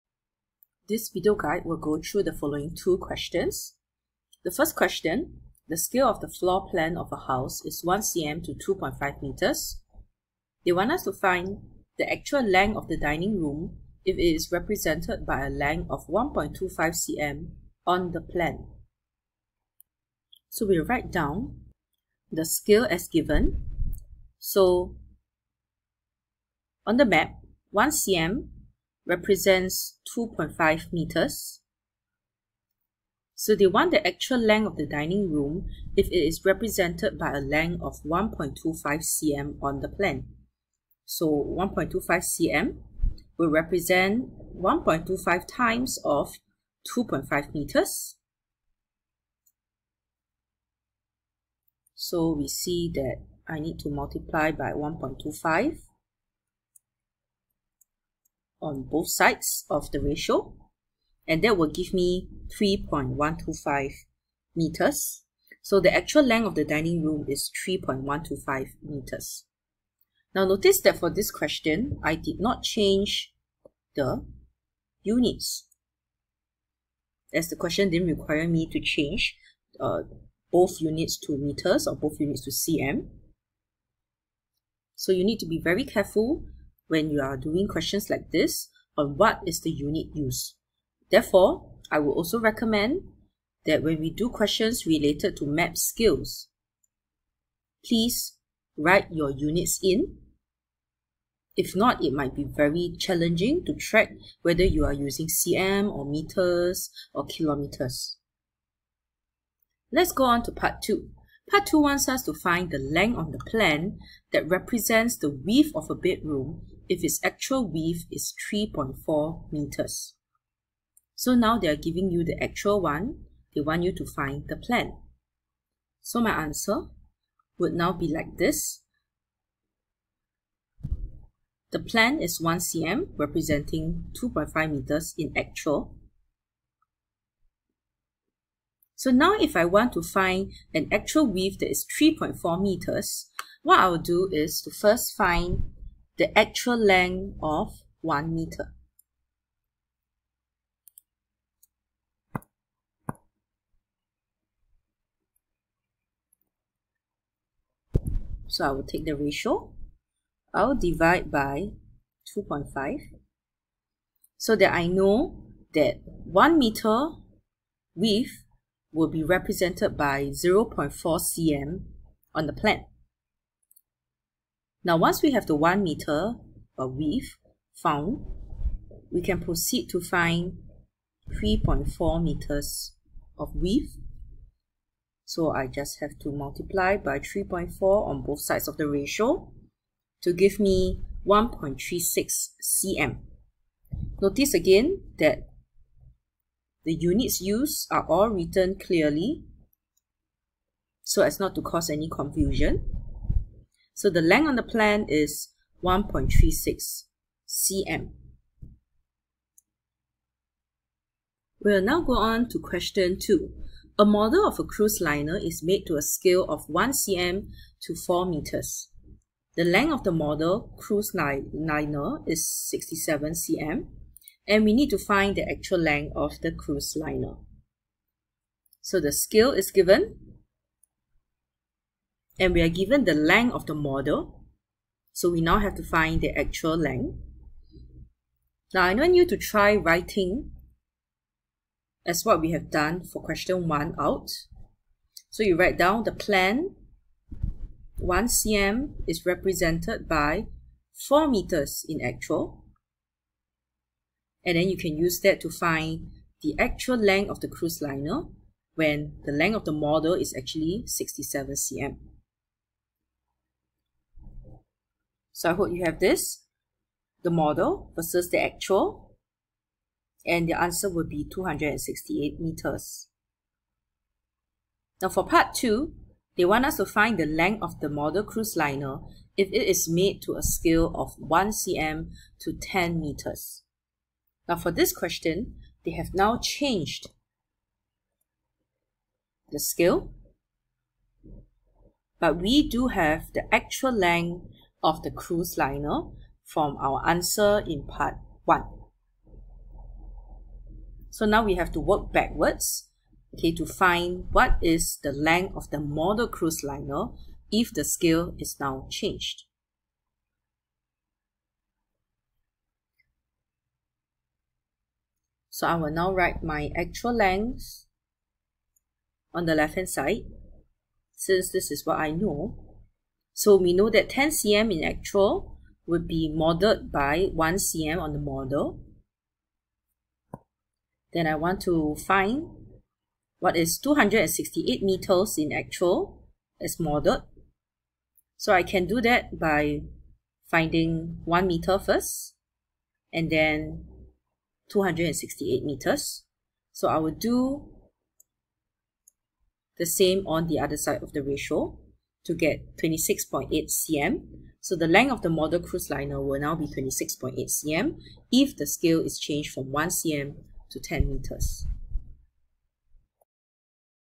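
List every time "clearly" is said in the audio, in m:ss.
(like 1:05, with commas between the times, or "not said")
3:18.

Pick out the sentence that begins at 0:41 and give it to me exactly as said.
So 1.25 cm will represent 1.25 times of 2.5 meters.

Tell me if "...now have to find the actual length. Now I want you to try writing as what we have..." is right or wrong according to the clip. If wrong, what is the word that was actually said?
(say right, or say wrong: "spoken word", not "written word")
right.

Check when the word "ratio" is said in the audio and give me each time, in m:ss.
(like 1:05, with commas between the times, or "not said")
0:59, 2:39, 3:08, 5:51.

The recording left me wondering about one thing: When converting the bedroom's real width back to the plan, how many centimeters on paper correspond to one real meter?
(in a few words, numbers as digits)
0.4 cm.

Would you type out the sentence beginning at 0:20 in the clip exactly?
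So we write down the scale as given.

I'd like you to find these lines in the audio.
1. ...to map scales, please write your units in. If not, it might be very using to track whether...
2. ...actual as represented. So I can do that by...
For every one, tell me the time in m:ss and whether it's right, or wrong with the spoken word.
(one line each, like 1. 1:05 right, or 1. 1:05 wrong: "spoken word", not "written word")
1. 1:35 wrong: "challenging", not "using"
2. 5:35 wrong: "modeled", not "represented".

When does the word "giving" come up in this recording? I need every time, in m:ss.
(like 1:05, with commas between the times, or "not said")
2:01.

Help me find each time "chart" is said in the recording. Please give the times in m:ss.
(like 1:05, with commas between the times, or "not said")
not said.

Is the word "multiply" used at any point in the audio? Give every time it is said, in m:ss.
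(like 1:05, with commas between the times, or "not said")
0:53, 3:06.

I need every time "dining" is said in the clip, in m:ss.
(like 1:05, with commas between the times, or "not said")
0:12, 0:34, 1:06.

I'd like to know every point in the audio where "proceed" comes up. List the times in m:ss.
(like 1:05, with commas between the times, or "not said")
2:59.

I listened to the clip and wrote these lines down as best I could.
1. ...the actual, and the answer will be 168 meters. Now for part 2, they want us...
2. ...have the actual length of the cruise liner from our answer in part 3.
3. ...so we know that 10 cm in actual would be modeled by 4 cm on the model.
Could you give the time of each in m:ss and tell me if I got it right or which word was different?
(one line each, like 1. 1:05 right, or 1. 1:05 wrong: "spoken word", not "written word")
1. 4:28 wrong: "268", not "168"
2. 4:52 wrong: "1", not "3"
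3. 5:23 wrong: "1", not "4".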